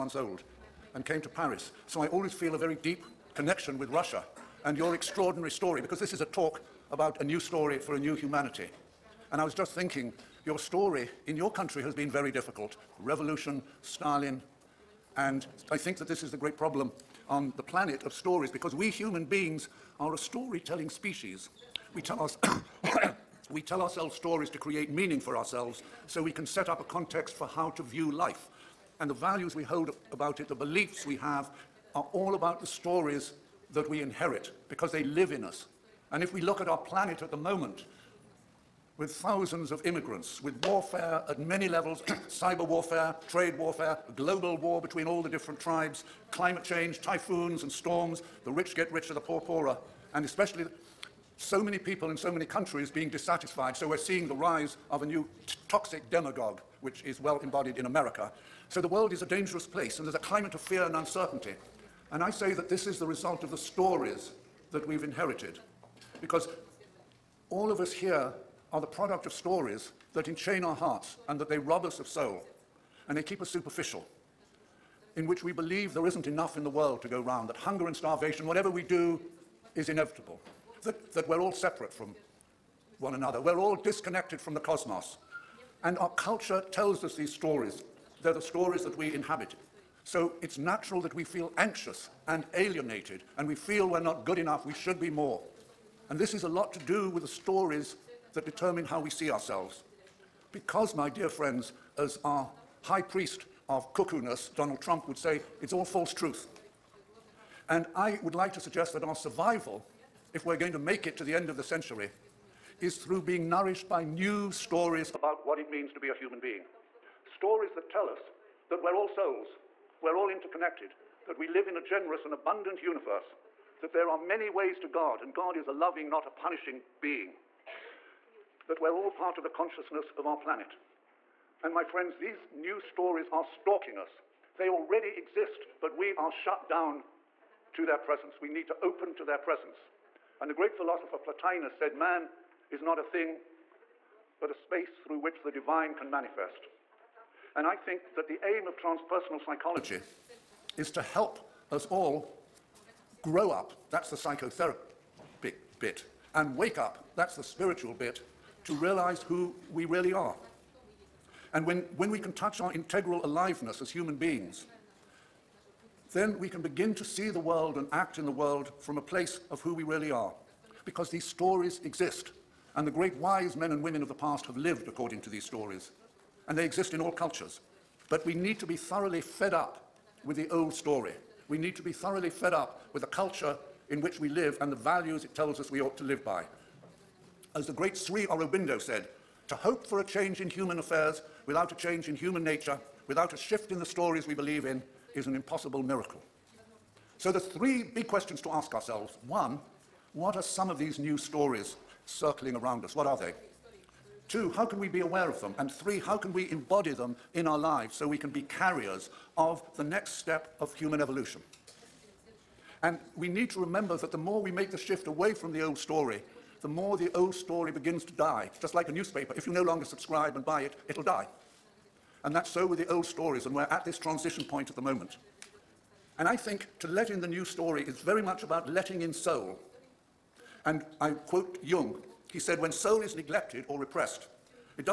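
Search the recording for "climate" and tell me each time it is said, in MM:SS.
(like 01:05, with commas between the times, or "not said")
00:46, 01:00.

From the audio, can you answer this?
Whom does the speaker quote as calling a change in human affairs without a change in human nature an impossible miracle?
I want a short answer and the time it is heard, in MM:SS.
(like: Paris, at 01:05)
Sri Aurobindo, at 03:07.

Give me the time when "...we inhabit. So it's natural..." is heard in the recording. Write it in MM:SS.
01:28.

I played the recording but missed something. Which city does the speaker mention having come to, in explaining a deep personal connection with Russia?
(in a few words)
Paris.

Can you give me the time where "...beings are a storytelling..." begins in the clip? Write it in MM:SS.
00:19.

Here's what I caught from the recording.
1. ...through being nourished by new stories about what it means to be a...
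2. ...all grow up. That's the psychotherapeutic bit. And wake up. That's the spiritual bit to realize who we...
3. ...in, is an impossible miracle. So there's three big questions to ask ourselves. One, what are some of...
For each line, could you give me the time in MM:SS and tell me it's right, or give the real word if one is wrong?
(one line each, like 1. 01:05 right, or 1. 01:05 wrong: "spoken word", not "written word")
1. 01:52 right
2. 02:31 right
3. 03:14 right.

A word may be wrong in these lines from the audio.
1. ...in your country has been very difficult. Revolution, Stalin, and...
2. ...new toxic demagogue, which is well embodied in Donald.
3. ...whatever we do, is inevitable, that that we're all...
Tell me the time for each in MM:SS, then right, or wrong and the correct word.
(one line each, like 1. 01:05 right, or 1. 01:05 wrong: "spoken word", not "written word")
1. 00:11 right
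2. 00:55 wrong: "America", not "Donald"
3. 01:18 right.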